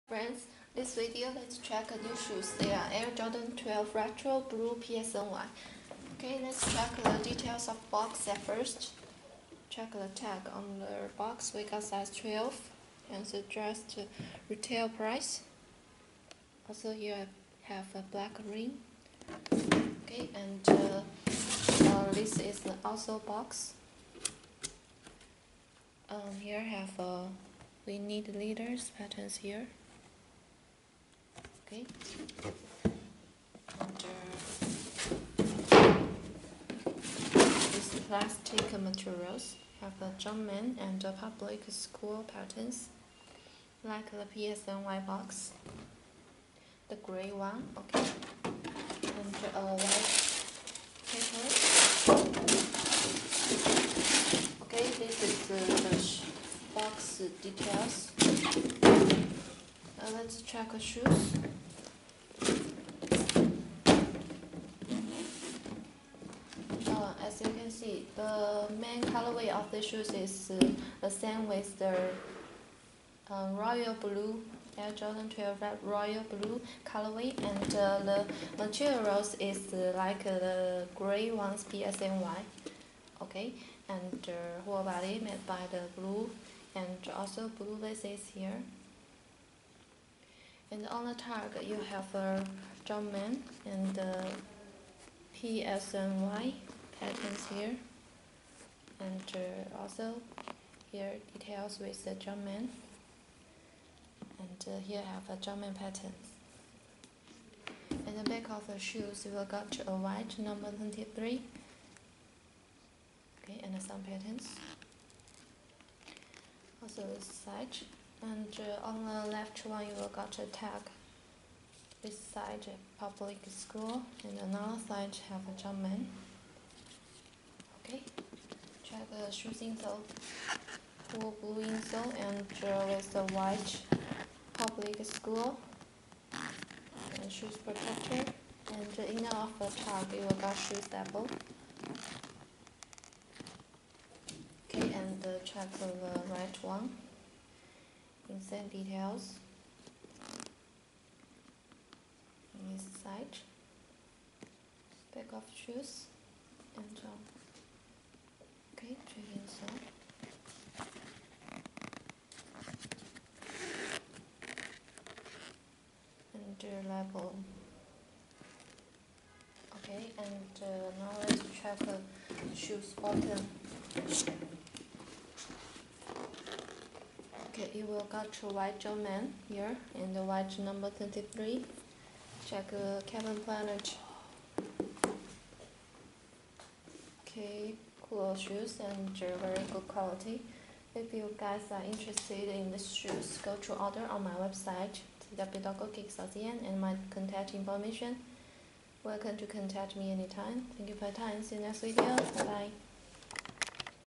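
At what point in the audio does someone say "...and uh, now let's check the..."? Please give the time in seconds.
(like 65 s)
170 s.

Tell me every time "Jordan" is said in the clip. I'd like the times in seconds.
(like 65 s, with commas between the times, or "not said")
3 s, 74 s.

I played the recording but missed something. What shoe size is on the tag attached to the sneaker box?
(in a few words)
12.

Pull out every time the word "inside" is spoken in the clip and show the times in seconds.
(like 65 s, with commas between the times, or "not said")
152 s.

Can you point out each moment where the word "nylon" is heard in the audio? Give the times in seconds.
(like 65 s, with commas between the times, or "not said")
not said.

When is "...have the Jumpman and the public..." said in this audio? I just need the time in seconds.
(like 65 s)
39 s.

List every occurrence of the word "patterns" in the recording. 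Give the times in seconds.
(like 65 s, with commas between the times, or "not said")
28 s, 42 s, 96 s, 105 s, 114 s.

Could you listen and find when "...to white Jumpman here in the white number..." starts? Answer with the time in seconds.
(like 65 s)
178 s.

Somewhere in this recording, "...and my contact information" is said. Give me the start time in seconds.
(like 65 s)
196 s.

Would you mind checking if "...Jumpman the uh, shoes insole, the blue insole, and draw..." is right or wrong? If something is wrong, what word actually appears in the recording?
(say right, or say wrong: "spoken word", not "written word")
right.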